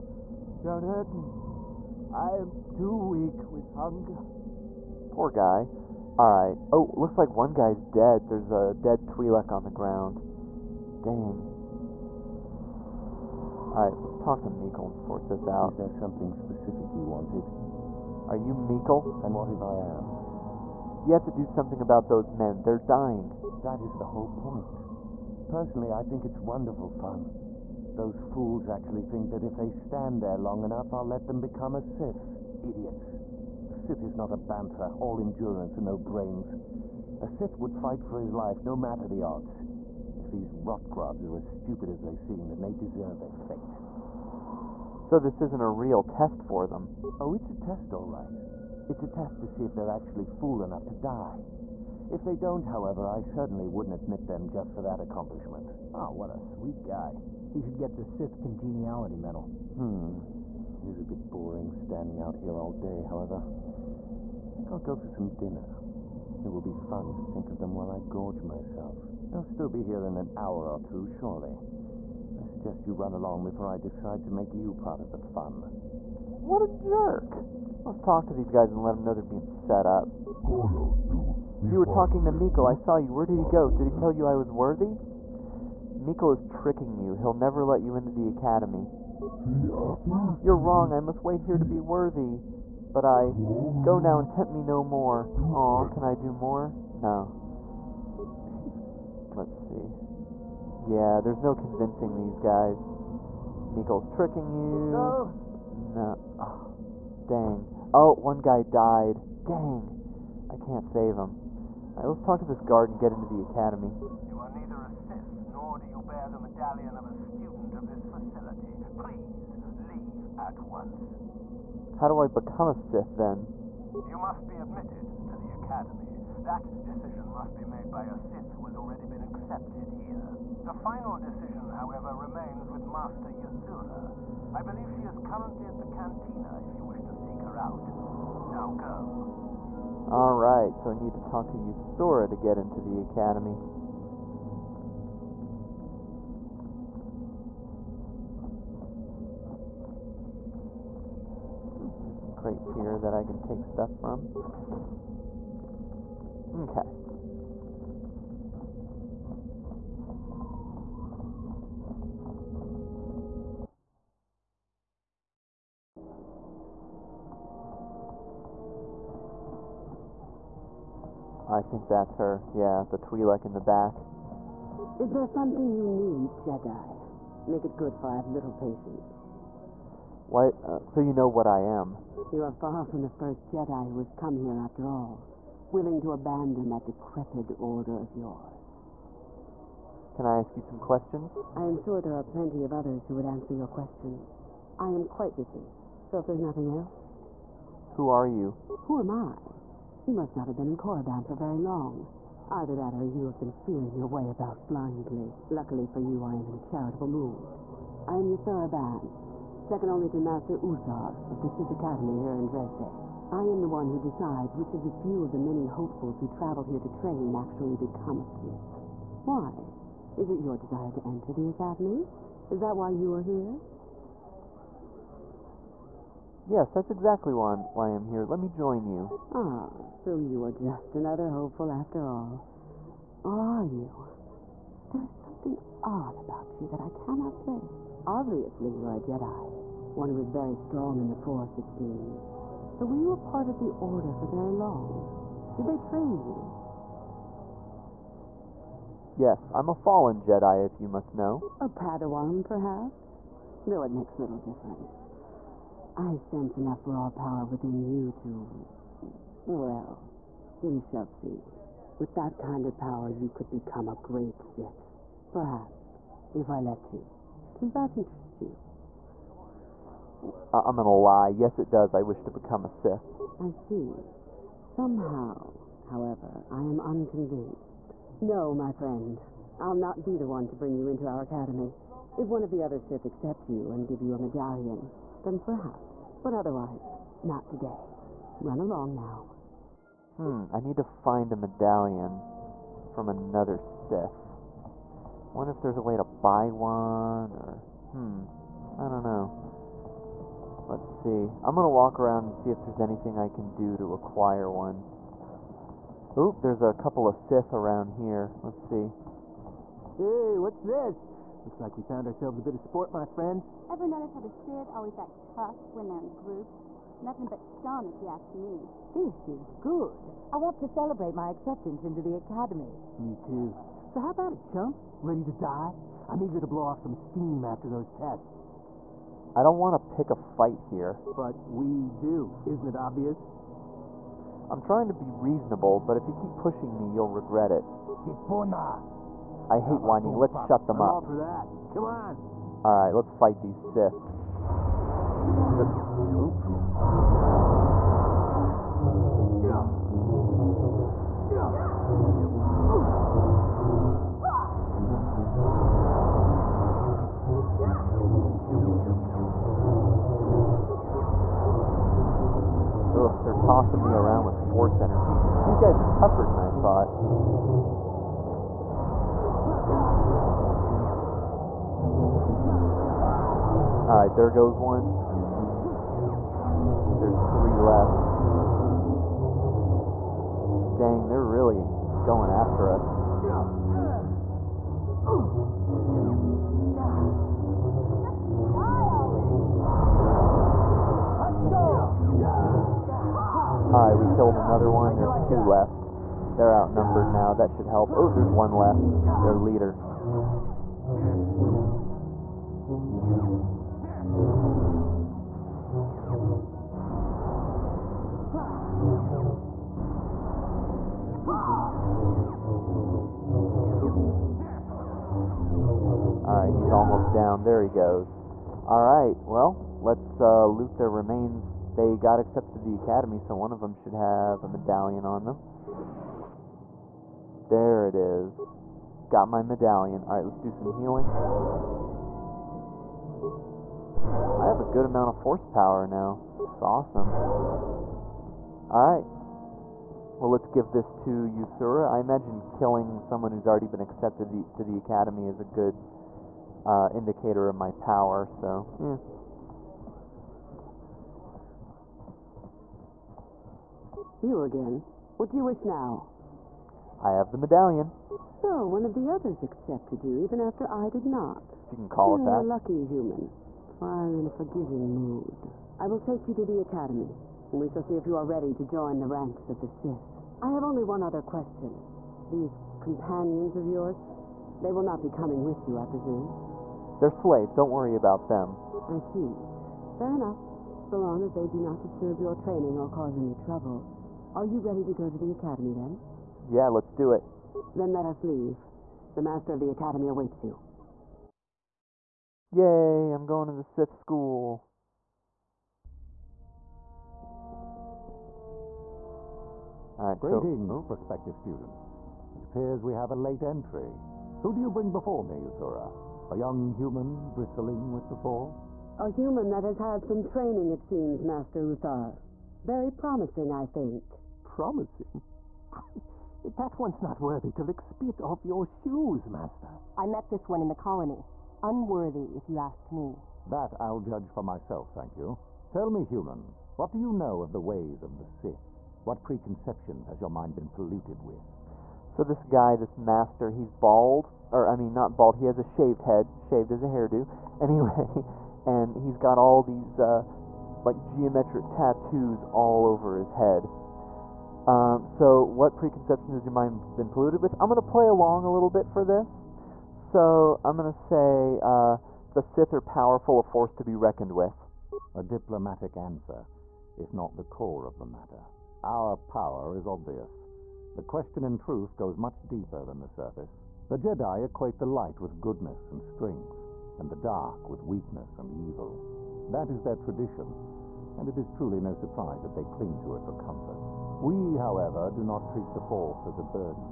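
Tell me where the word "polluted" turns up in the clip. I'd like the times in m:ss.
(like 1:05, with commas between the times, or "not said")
8:50, 9:07.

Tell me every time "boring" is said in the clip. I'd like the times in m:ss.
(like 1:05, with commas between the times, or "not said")
1:01.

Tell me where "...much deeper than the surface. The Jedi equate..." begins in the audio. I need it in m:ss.
9:22.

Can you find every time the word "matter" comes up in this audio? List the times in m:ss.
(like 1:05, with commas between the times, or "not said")
0:38, 9:18.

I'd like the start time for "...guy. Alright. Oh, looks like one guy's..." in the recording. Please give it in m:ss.
0:05.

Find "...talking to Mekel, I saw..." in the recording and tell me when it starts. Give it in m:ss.
1:21.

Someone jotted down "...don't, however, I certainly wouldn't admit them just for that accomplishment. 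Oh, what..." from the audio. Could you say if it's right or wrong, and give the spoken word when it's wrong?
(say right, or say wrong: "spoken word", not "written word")
right.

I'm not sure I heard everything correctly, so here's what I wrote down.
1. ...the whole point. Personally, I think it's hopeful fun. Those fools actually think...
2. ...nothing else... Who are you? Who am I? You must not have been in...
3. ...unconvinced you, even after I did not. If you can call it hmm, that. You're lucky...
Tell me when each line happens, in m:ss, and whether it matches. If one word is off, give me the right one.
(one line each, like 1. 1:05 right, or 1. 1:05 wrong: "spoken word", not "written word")
1. 0:23 wrong: "wonderful", not "hopeful"
2. 3:16 right
3. 7:39 wrong: "accepted", not "unconvinced".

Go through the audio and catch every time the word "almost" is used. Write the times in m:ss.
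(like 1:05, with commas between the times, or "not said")
6:56.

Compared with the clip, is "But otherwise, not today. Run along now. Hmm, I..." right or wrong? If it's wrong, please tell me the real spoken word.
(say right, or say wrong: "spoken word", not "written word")
right.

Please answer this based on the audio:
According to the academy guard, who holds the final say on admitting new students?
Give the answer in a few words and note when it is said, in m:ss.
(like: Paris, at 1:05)
Master Yuthura, at 2:12.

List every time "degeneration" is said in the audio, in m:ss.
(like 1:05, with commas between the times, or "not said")
not said.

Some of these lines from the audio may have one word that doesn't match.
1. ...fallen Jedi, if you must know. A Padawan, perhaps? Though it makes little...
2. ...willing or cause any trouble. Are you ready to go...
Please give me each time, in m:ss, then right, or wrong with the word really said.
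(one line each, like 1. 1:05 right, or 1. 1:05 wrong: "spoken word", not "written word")
1. 4:09 right
2. 8:02 wrong: "training", not "willing".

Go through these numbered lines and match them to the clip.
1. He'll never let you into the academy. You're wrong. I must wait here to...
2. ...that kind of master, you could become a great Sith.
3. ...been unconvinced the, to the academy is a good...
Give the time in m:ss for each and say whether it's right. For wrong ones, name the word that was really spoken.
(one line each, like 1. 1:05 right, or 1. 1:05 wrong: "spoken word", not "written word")
1. 1:27 right
2. 4:22 wrong: "power", not "master"
3. 7:23 wrong: "accepted", not "unconvinced".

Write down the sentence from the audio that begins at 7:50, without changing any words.
I have only one other question.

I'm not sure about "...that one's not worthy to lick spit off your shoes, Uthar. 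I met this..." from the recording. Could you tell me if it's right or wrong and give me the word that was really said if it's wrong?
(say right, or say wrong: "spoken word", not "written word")
wrong: "Master", not "Uthar".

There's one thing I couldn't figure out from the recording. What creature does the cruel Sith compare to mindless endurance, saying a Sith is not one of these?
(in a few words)
Bantha.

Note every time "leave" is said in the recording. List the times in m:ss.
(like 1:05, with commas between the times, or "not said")
1:59, 8:08.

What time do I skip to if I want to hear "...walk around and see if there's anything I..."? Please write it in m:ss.
5:01.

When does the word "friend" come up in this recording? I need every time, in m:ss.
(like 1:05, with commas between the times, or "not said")
4:38, 5:13.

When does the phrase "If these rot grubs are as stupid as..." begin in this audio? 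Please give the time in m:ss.
0:40.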